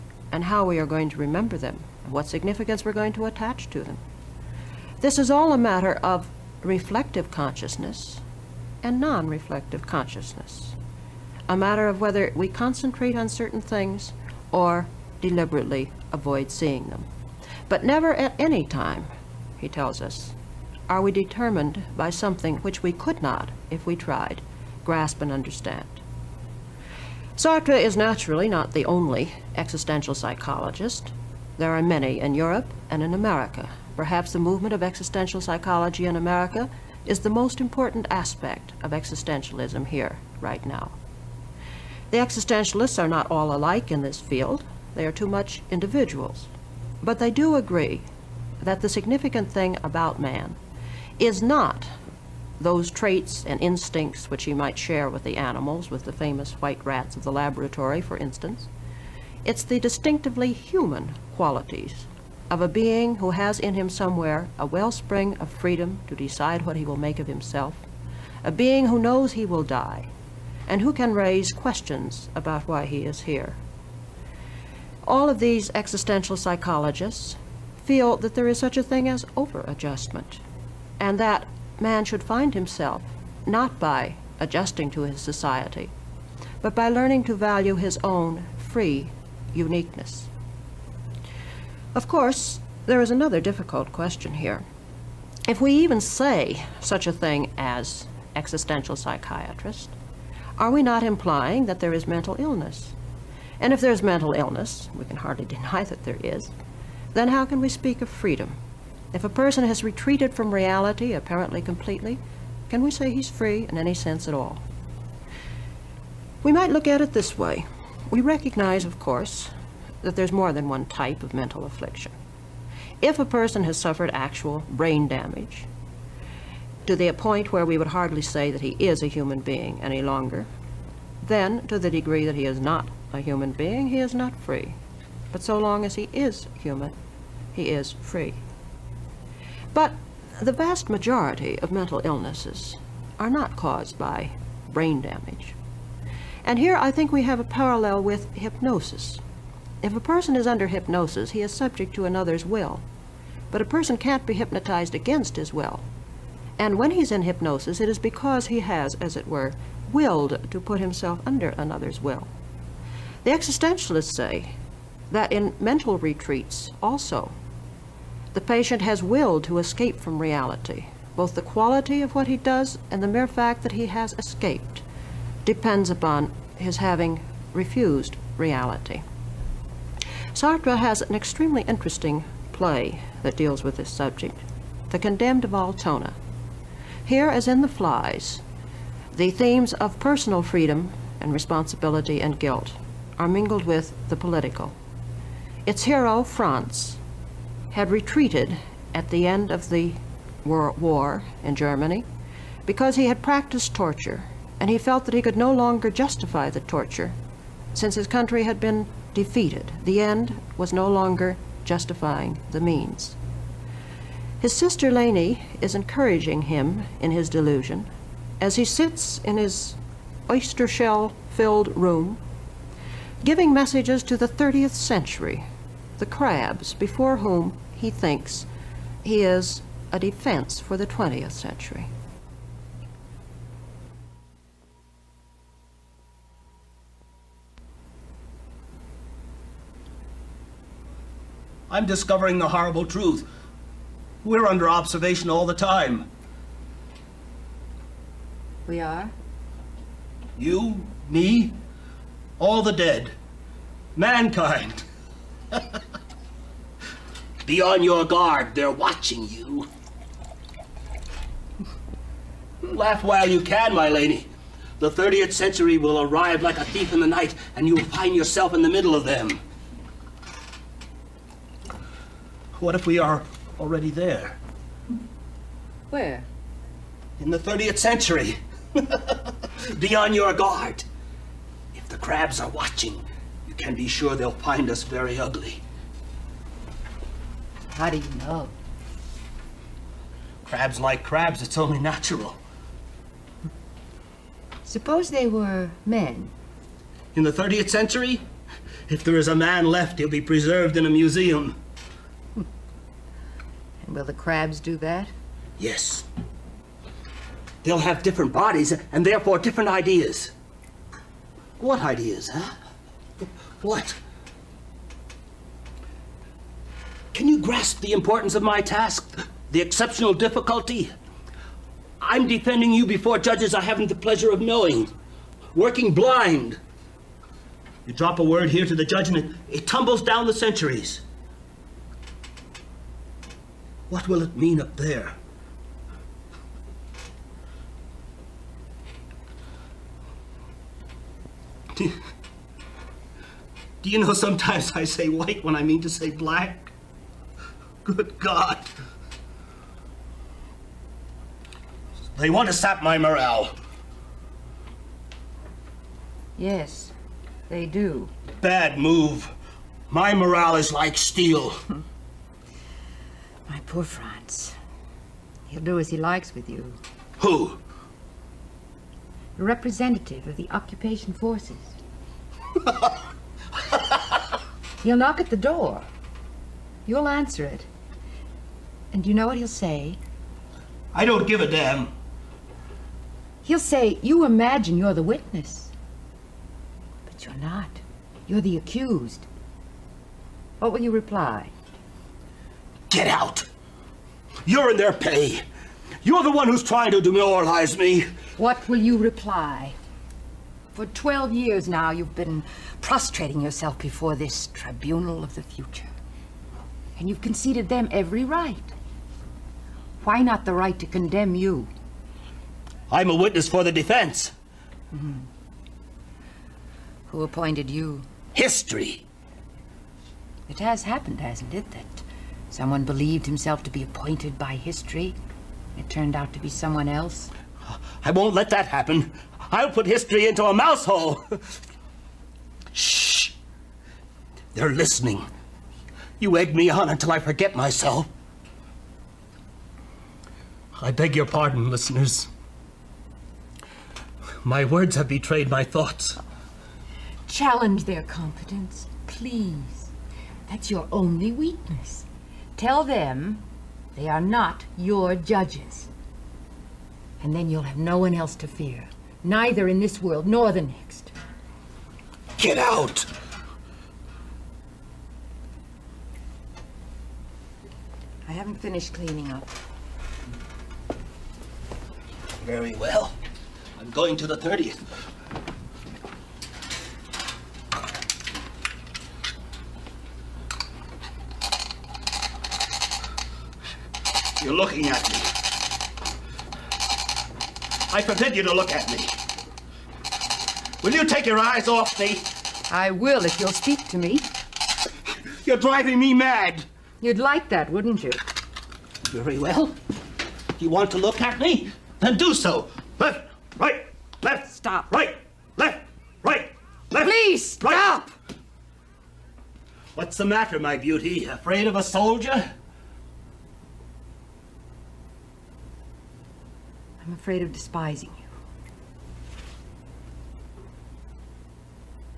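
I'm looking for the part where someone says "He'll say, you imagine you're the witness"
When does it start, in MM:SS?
06:23.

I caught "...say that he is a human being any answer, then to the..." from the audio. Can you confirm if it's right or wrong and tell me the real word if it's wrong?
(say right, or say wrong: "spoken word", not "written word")
wrong: "longer", not "answer".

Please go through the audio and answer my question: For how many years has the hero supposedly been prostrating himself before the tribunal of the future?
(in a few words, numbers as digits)
12.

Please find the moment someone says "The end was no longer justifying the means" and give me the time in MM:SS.
03:29.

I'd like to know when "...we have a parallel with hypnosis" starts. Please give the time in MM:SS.
02:27.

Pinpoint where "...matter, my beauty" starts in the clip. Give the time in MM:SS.
08:30.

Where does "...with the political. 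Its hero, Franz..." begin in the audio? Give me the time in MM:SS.
03:13.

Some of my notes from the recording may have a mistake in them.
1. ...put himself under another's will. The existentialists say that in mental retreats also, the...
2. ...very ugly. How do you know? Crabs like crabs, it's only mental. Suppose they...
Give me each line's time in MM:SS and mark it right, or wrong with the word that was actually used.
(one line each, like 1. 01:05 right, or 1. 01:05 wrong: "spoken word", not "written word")
1. 02:40 right
2. 04:44 wrong: "natural", not "mental".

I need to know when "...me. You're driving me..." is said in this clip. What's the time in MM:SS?
08:13.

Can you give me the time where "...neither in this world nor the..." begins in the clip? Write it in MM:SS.
07:39.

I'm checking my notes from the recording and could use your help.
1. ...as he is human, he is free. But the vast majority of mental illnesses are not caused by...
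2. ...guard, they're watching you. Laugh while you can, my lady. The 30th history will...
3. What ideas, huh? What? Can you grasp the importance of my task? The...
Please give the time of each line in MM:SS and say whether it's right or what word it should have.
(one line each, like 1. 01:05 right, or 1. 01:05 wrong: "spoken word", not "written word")
1. 02:15 right
2. 04:18 wrong: "century", not "history"
3. 05:11 right.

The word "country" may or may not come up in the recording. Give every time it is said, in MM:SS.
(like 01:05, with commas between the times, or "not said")
03:28.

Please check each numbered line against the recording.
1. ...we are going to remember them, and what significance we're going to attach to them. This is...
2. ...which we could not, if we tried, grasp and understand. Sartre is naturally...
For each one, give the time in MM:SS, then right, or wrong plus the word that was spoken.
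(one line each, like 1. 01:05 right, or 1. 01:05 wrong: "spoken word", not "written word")
1. 00:00 right
2. 00:22 right.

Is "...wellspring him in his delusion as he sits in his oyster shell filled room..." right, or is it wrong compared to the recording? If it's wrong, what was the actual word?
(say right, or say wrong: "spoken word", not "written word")
wrong: "encouraging", not "wellspring".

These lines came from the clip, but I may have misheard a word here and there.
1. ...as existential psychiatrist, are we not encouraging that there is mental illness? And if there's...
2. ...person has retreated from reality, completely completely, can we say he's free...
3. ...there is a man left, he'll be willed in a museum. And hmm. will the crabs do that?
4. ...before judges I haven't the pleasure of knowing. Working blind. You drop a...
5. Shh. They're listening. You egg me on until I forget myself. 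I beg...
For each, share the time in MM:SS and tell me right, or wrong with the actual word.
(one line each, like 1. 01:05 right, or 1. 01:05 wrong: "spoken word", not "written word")
1. 01:37 wrong: "implying", not "encouraging"
2. 01:49 wrong: "apparently", not "completely"
3. 04:59 wrong: "preserved", not "willed"
4. 05:22 right
5. 07:12 right.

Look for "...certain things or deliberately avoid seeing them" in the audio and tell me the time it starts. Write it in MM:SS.
00:13.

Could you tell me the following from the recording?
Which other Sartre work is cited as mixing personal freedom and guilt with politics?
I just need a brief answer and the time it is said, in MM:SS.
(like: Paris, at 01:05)
The Flies, at 03:07.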